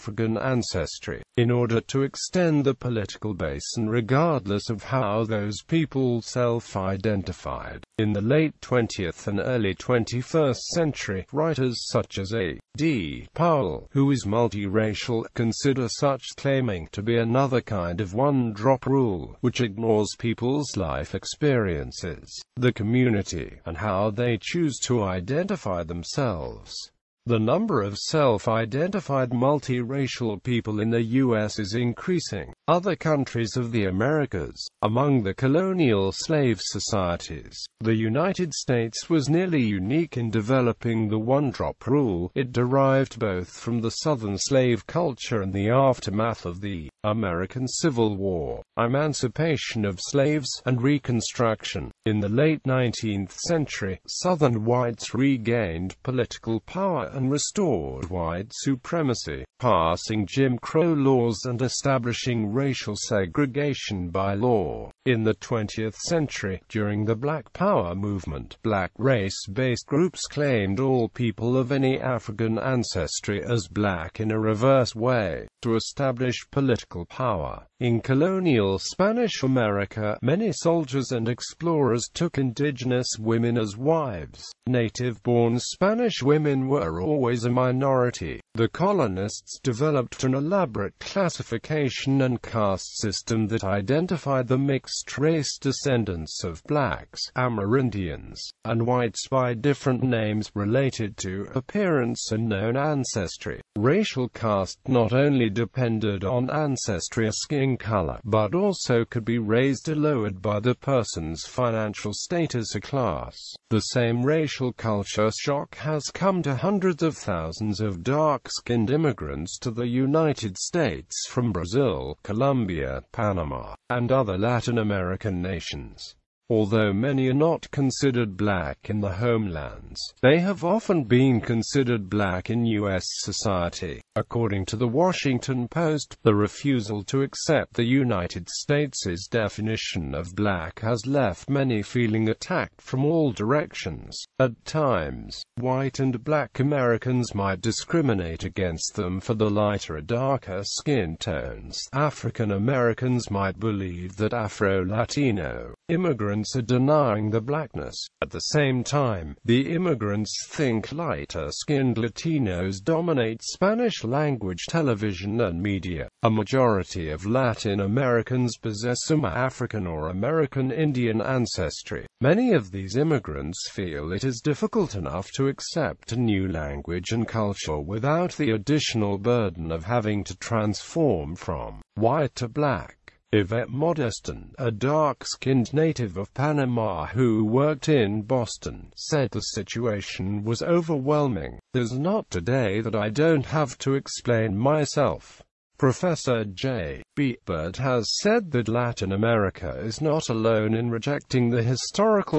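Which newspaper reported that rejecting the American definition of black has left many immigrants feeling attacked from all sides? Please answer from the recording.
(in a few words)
The Washington Post.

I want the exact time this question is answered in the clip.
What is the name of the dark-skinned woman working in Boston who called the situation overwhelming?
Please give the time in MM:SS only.
03:03.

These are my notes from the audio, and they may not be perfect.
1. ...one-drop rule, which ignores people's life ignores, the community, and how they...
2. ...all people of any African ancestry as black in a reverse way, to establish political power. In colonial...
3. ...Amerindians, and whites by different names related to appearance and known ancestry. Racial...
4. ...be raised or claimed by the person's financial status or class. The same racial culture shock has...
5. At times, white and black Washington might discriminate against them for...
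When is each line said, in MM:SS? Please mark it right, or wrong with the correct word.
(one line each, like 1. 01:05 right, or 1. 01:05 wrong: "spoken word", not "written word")
1. 00:18 wrong: "experiences", not "ignores"
2. 01:10 right
3. 01:37 right
4. 01:49 wrong: "lowered", not "claimed"
5. 02:24 wrong: "Americans", not "Washington".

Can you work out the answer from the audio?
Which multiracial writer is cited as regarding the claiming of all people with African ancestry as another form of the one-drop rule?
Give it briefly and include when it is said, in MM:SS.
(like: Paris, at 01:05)
A. D. Powell, at 00:12.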